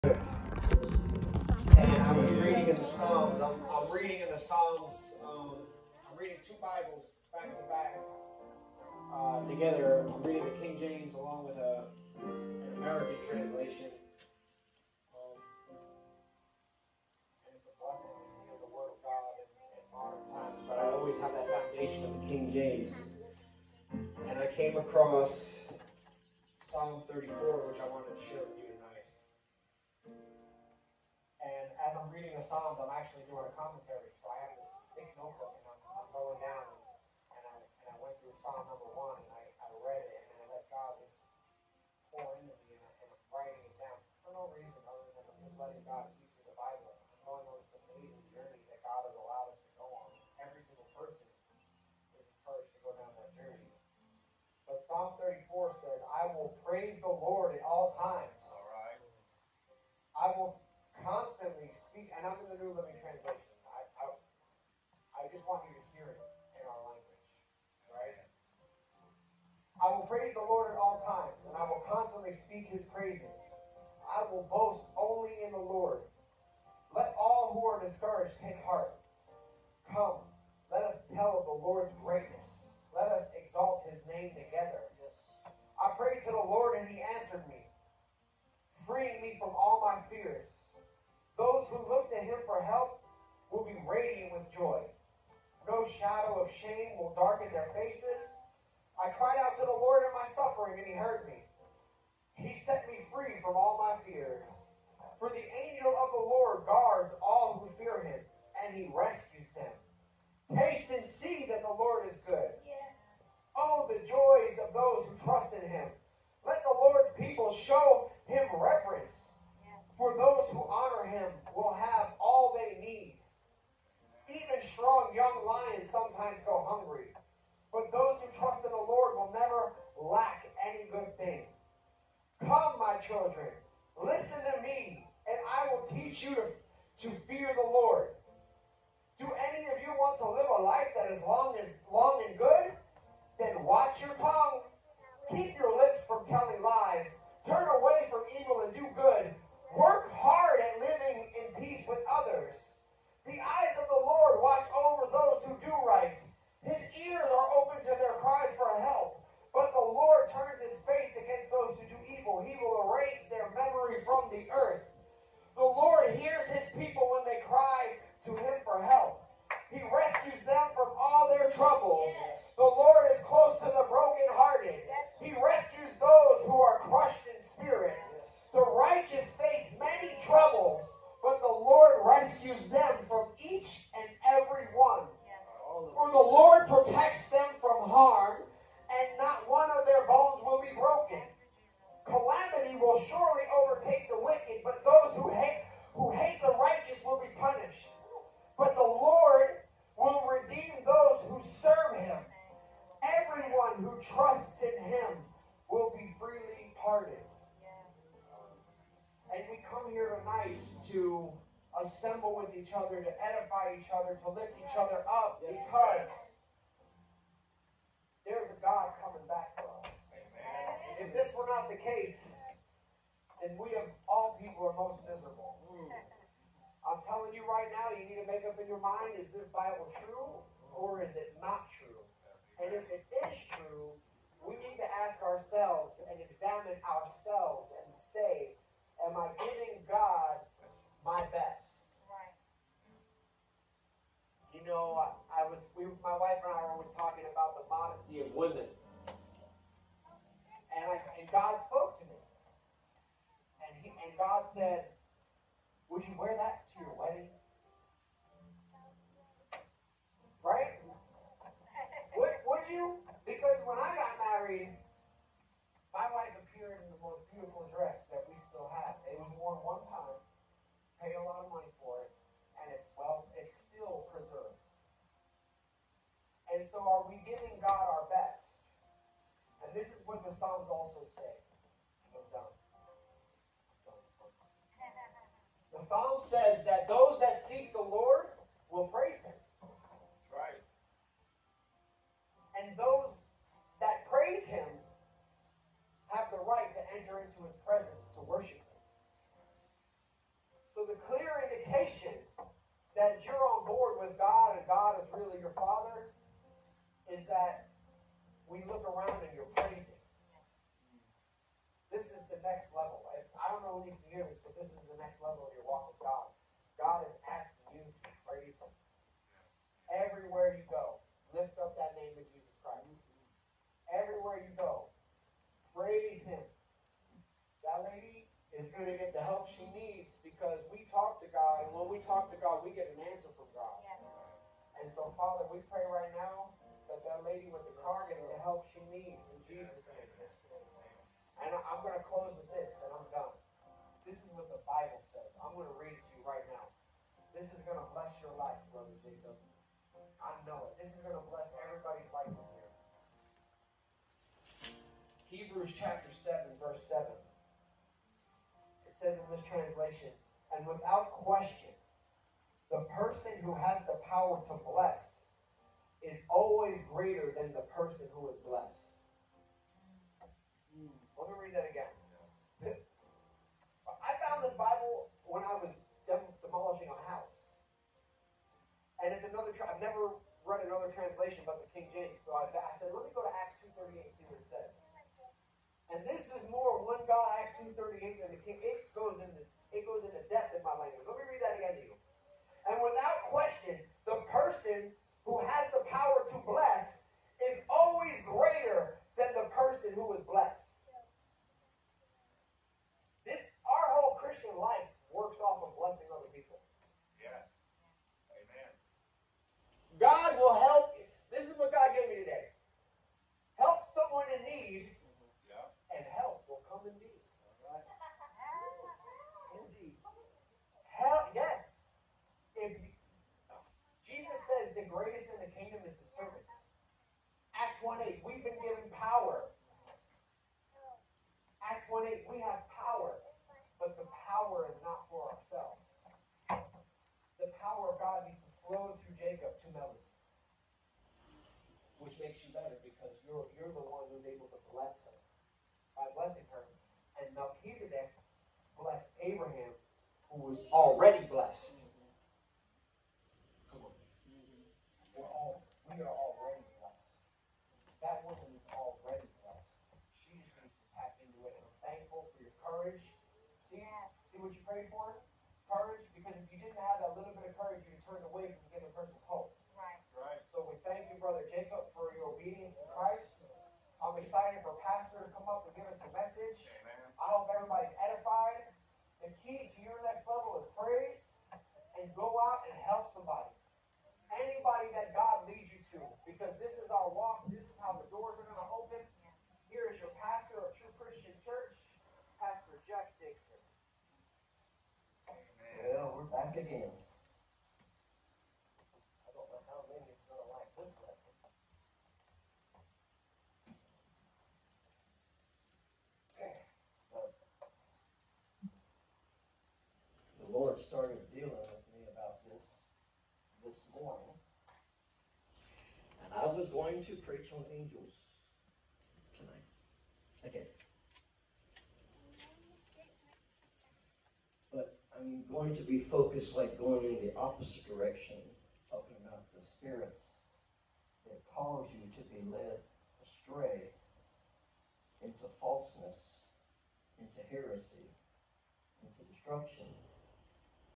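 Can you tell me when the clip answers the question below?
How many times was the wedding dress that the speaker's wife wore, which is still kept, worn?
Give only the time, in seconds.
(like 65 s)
269 s.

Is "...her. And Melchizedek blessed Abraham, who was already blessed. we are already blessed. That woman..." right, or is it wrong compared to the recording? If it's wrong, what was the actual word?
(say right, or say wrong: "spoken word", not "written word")
right.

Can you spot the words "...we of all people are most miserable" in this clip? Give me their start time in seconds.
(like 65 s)
223 s.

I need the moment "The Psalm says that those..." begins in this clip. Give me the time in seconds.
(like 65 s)
285 s.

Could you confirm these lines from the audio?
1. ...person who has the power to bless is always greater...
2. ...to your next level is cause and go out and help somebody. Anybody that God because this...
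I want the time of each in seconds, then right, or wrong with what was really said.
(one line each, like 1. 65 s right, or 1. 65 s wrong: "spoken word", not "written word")
1. 362 s right
2. 479 s wrong: "praise", not "cause".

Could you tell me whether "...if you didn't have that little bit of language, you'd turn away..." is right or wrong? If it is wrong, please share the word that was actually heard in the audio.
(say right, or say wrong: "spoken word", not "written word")
wrong: "courage", not "language".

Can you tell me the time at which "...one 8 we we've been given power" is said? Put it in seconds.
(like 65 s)
427 s.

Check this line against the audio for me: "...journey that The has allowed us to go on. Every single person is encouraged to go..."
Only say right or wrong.
wrong.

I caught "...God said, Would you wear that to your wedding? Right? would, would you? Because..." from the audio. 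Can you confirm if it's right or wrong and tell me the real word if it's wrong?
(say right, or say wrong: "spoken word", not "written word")
right.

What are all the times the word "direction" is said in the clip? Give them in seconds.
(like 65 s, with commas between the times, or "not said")
527 s.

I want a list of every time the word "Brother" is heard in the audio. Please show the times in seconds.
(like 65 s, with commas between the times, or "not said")
348 s, 471 s.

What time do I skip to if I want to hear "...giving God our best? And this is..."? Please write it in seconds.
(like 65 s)
277 s.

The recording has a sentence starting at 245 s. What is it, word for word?
we, my wife and I were always talking about the modesty of women.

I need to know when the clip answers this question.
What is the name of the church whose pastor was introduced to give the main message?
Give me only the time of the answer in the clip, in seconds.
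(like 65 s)
490 s.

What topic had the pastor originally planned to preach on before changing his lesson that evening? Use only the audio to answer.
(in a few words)
Angels.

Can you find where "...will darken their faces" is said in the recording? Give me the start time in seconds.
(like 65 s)
96 s.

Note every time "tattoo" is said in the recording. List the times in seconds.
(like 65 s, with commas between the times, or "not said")
not said.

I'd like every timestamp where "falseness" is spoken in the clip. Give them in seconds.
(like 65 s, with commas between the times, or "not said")
535 s.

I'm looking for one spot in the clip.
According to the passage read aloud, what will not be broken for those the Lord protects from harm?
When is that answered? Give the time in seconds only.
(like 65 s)
190 s.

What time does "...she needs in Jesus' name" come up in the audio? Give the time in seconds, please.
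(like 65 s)
338 s.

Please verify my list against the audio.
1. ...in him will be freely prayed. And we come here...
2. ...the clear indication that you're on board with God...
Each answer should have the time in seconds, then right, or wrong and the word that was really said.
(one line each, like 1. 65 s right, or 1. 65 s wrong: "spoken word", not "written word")
1. 204 s wrong: "pardoned", not "prayed"
2. 300 s right.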